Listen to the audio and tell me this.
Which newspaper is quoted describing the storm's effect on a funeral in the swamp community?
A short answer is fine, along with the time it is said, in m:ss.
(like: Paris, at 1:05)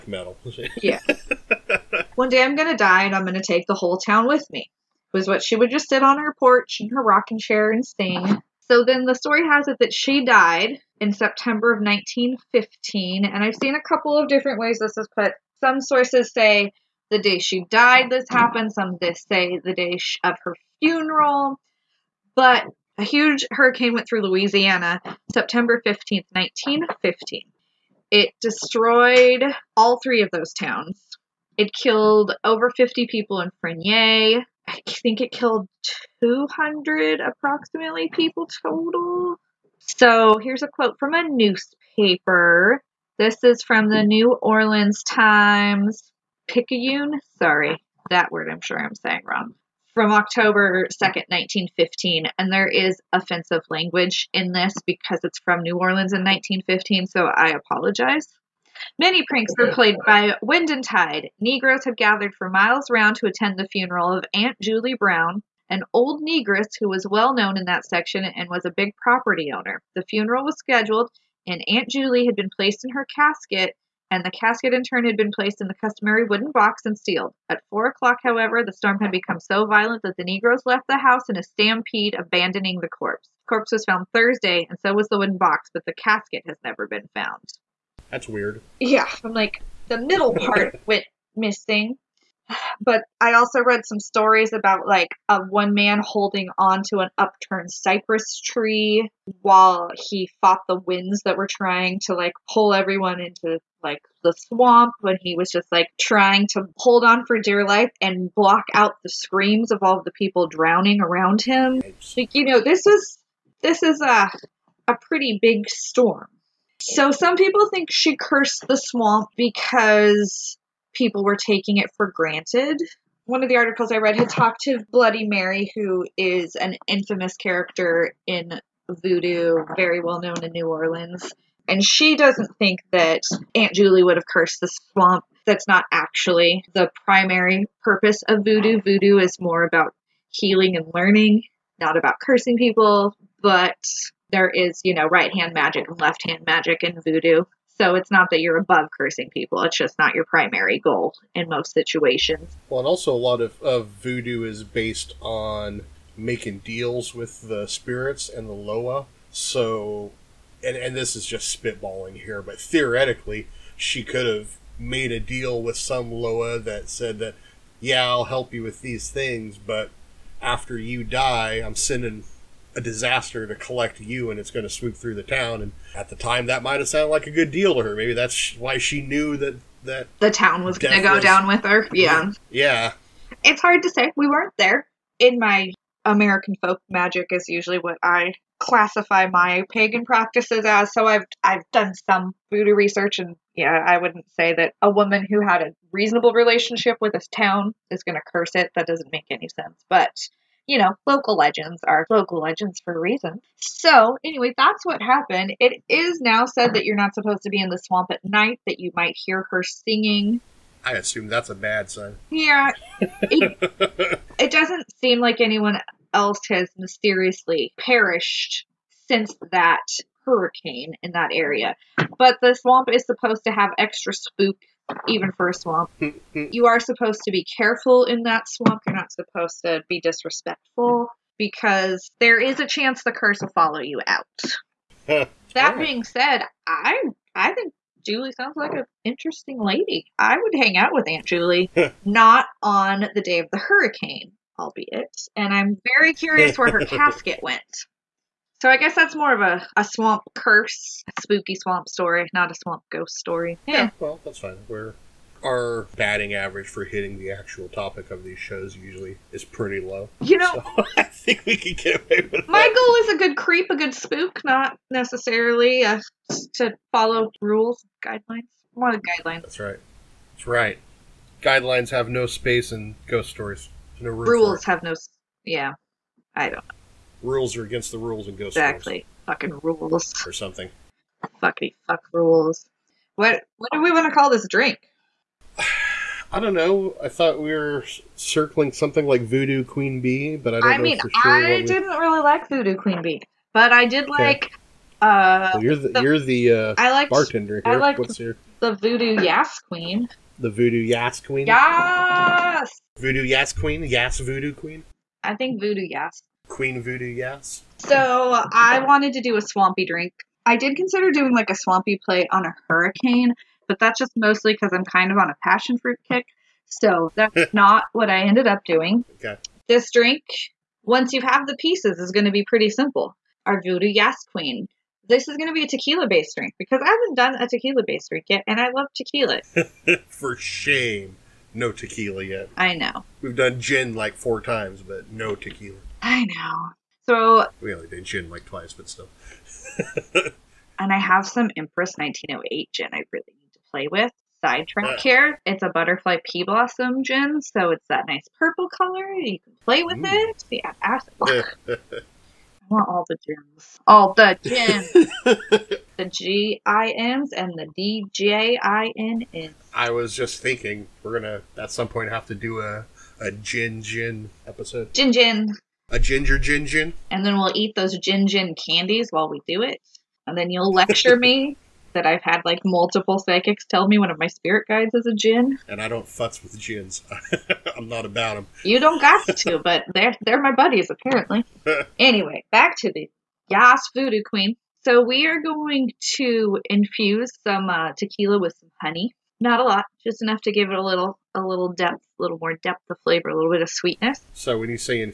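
New Orleans Times Picayune, at 0:44.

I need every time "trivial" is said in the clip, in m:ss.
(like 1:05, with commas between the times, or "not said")
not said.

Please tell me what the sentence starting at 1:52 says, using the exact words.
Like you know, this is this is a a pretty big storm.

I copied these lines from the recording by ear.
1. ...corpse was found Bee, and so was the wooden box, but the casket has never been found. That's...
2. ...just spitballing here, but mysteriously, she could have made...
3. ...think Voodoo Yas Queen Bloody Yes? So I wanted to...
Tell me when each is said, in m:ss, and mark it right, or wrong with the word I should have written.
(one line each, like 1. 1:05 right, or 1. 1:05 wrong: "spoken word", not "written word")
1. 1:23 wrong: "Thursday", not "Bee"
2. 2:41 wrong: "theoretically", not "mysteriously"
3. 5:05 wrong: "Voodoo", not "Bloody".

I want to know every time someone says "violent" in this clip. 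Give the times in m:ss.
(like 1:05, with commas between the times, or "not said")
1:19.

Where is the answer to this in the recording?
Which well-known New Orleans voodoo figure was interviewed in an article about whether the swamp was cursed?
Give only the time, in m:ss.
2:04.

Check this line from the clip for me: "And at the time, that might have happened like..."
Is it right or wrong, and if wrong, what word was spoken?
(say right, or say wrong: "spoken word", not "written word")
wrong: "sounded", not "happened".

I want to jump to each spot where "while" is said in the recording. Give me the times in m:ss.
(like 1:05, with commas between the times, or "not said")
1:39, 6:09.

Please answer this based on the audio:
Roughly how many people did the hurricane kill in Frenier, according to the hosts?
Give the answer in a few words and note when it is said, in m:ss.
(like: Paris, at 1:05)
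over 50, at 0:32.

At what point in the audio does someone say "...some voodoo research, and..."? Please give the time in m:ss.
3:12.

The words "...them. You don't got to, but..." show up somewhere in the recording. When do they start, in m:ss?
6:18.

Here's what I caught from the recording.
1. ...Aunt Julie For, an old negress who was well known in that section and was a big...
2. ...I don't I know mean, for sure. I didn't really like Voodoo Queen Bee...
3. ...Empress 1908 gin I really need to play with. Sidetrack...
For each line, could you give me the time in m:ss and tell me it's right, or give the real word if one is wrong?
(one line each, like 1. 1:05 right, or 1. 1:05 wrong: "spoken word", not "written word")
1. 1:04 wrong: "Brown", not "For"
2. 4:50 right
3. 5:41 right.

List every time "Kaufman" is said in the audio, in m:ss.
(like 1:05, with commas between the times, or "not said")
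not said.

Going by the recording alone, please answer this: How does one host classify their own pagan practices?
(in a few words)
American folk magic.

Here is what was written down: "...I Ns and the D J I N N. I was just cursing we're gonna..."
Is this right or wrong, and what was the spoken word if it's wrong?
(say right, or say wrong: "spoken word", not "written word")
wrong: "thinking", not "cursing".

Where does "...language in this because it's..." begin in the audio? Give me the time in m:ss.
0:53.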